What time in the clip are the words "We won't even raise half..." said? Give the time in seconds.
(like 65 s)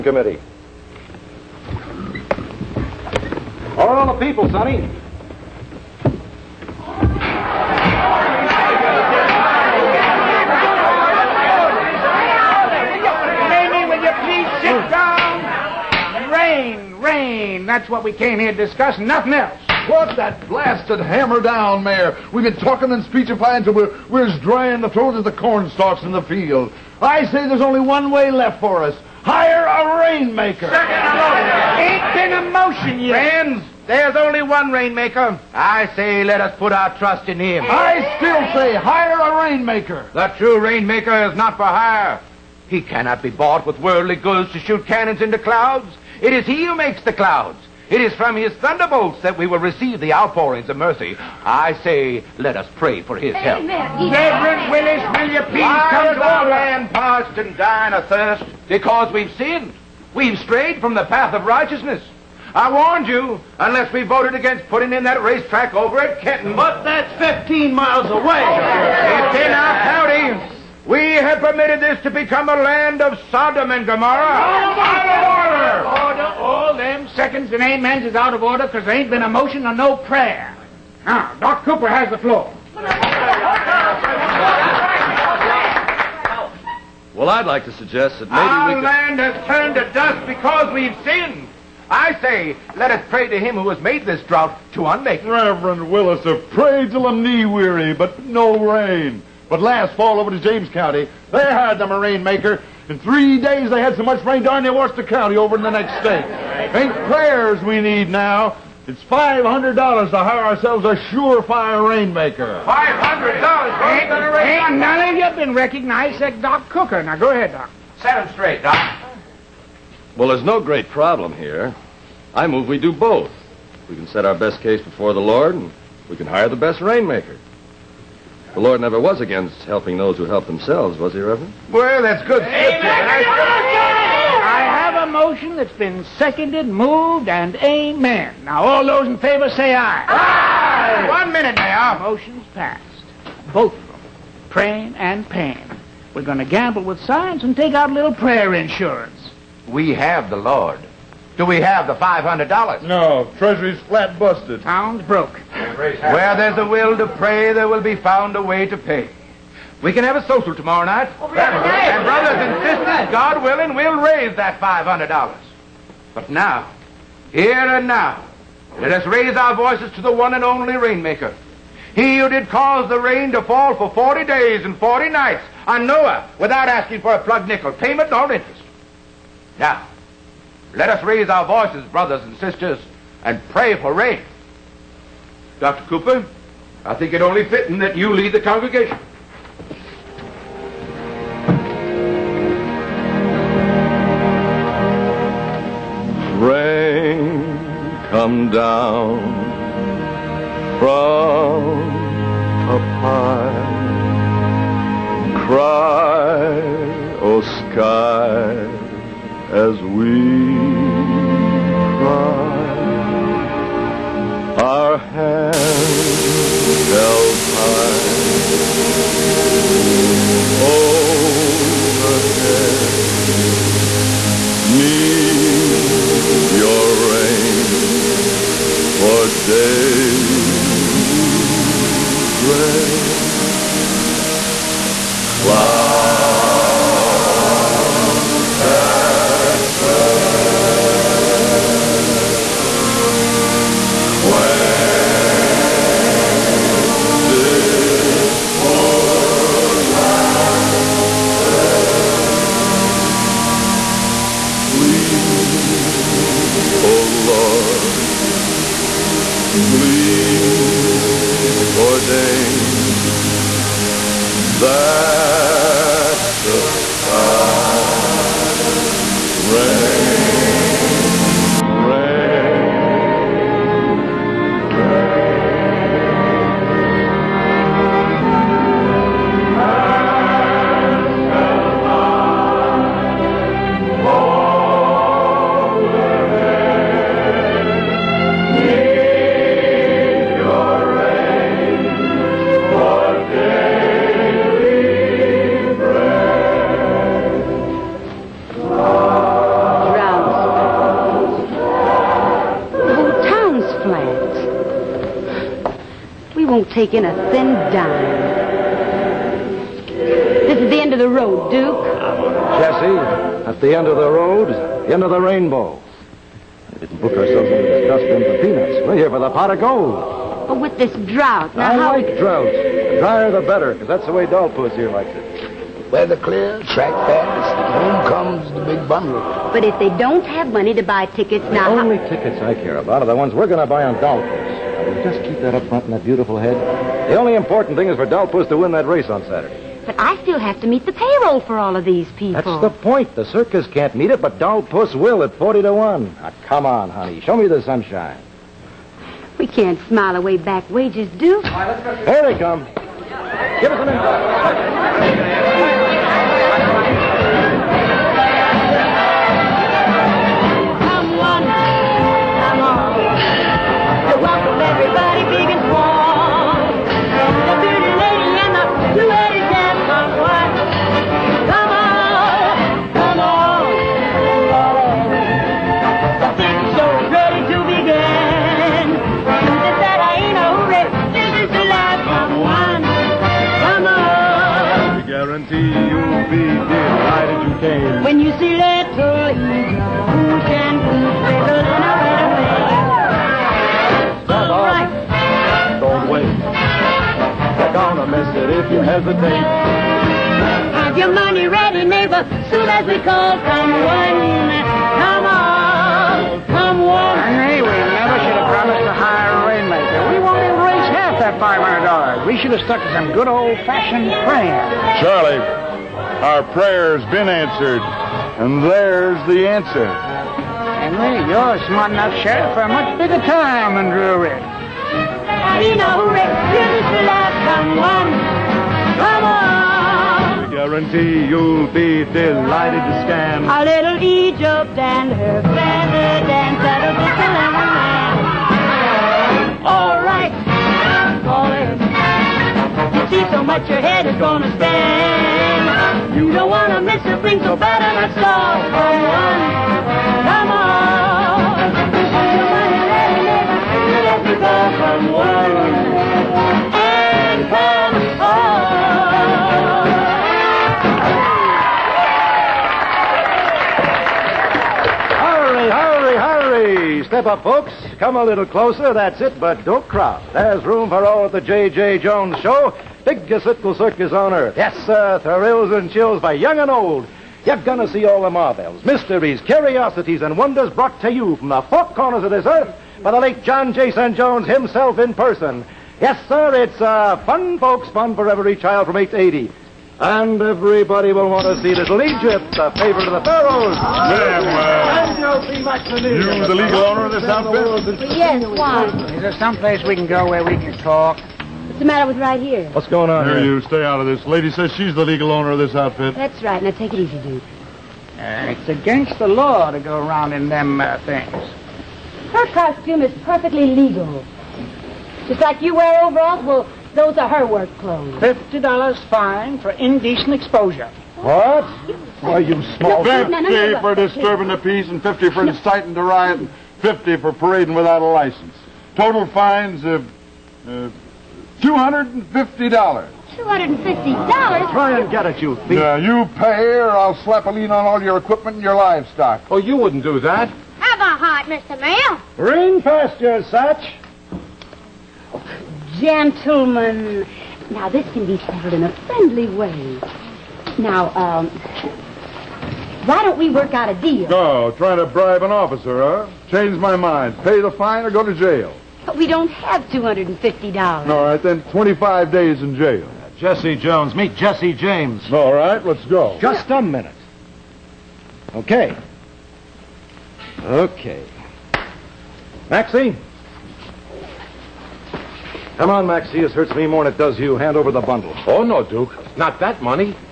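410 s.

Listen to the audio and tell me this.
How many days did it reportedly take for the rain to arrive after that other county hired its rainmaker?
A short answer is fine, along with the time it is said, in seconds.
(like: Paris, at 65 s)
3 days, at 102 s.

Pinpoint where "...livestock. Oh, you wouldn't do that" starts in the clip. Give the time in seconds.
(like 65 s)
538 s.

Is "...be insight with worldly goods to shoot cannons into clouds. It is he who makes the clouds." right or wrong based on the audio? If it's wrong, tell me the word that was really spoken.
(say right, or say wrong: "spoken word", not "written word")
wrong: "bought", not "insight".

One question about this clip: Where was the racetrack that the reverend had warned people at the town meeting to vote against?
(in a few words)
Kenton.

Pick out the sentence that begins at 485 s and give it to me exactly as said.
Yes, sir, it's uh, fun, folks, fun for every child from 8 to 80.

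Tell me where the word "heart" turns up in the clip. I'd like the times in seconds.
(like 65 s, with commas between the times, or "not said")
541 s.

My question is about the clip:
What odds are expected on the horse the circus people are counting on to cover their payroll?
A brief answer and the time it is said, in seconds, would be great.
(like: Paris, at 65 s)
40 to 1, at 345 s.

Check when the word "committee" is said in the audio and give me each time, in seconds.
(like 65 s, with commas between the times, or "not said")
0 s.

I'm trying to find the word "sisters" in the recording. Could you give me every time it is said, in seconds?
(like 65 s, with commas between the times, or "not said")
162 s, 182 s.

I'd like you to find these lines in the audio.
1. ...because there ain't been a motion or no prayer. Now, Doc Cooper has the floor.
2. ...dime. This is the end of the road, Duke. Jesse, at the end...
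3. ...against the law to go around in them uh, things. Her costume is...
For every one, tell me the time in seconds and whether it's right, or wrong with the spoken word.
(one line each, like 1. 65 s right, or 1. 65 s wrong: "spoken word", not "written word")
1. 78 s right
2. 307 s right
3. 508 s right.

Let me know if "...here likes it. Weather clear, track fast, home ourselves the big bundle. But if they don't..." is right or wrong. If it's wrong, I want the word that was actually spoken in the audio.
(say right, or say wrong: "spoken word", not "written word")
wrong: "comes", not "ourselves".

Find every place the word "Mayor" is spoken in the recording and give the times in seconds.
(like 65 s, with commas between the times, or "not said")
21 s, 141 s, 541 s.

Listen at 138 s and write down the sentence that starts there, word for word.
Now, all those in favor say aye.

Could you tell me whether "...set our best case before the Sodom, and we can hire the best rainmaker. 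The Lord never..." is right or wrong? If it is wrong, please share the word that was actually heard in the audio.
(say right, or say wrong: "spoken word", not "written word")
wrong: "Lord", not "Sodom".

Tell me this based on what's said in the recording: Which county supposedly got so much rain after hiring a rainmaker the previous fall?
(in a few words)
James County.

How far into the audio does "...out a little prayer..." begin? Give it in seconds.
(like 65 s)
147 s.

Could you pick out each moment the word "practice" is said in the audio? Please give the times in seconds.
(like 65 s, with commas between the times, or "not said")
not said.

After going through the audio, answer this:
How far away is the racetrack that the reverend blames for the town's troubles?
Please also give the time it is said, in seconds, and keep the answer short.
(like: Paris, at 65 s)
15 miles, at 67 s.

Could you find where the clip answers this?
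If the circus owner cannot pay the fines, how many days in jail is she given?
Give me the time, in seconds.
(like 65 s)
561 s.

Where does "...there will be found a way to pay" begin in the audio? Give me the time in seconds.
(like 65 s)
157 s.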